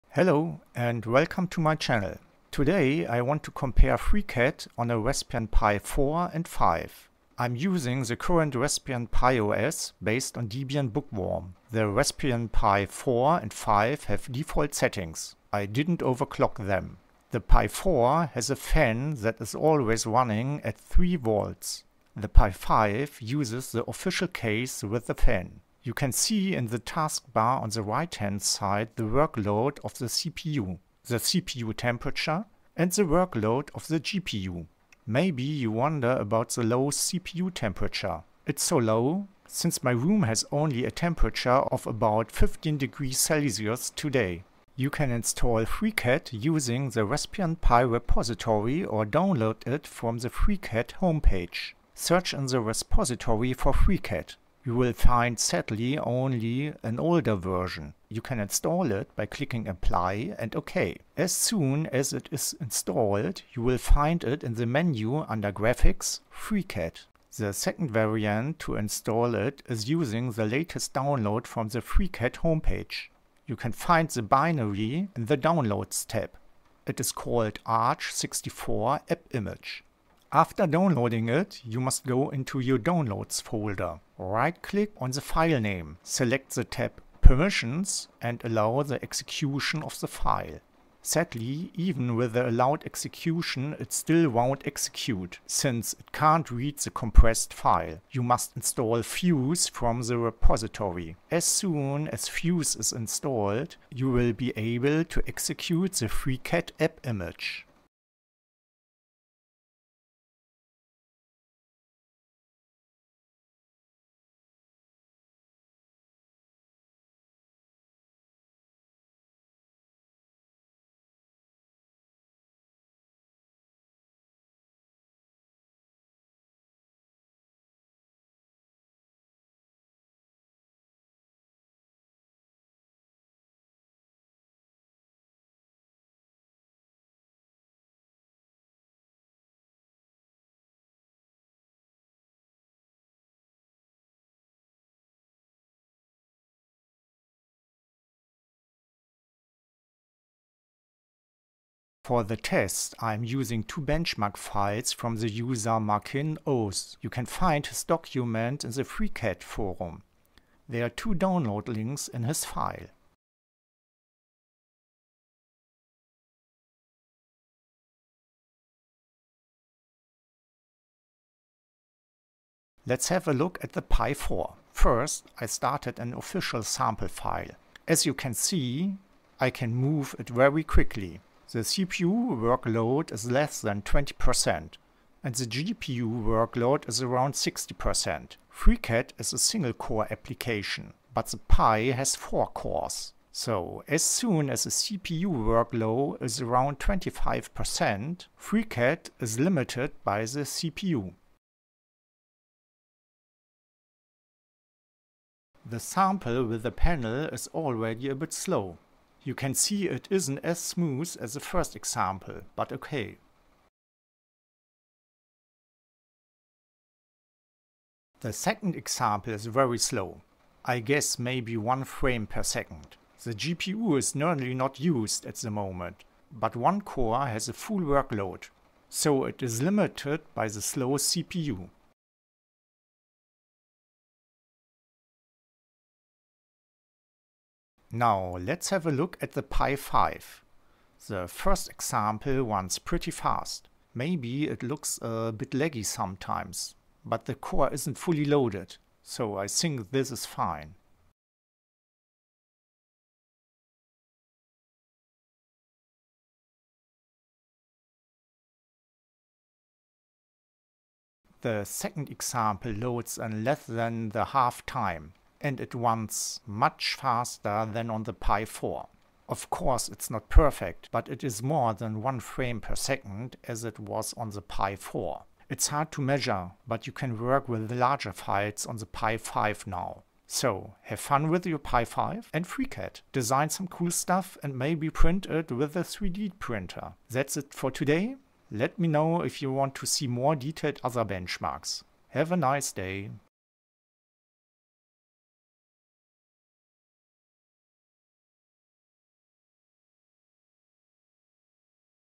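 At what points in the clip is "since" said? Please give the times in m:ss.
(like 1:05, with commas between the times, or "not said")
0:39, 1:35.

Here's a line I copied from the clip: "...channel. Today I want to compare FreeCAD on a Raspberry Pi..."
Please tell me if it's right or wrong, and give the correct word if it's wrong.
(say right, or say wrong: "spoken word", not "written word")
right.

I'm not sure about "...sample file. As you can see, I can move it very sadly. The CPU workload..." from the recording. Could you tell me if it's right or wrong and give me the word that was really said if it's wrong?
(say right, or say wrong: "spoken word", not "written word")
wrong: "quickly", not "sadly".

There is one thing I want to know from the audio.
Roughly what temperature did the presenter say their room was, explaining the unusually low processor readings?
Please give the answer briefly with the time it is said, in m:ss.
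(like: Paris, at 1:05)
15 degrees Celsius, at 0:42.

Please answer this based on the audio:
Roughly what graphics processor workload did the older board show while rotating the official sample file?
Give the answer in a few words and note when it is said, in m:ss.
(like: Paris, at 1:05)
60%, at 3:07.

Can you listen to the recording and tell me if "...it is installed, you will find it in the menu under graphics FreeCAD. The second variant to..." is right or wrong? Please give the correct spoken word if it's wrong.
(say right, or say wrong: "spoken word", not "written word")
right.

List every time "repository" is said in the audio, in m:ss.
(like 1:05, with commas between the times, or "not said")
0:47, 0:52, 1:40.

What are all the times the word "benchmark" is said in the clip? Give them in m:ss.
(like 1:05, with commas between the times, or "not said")
2:33, 4:51.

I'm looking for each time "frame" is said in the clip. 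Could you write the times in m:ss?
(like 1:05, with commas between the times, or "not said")
3:41, 4:32.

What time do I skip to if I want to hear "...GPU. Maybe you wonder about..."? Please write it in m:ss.
0:33.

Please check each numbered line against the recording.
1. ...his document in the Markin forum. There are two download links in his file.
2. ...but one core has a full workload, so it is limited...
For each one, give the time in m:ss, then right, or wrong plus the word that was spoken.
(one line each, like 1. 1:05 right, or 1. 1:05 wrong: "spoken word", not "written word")
1. 2:37 wrong: "FreeCAD", not "Markin"
2. 3:46 right.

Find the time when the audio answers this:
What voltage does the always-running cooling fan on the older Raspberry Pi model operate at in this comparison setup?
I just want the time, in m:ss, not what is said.
0:20.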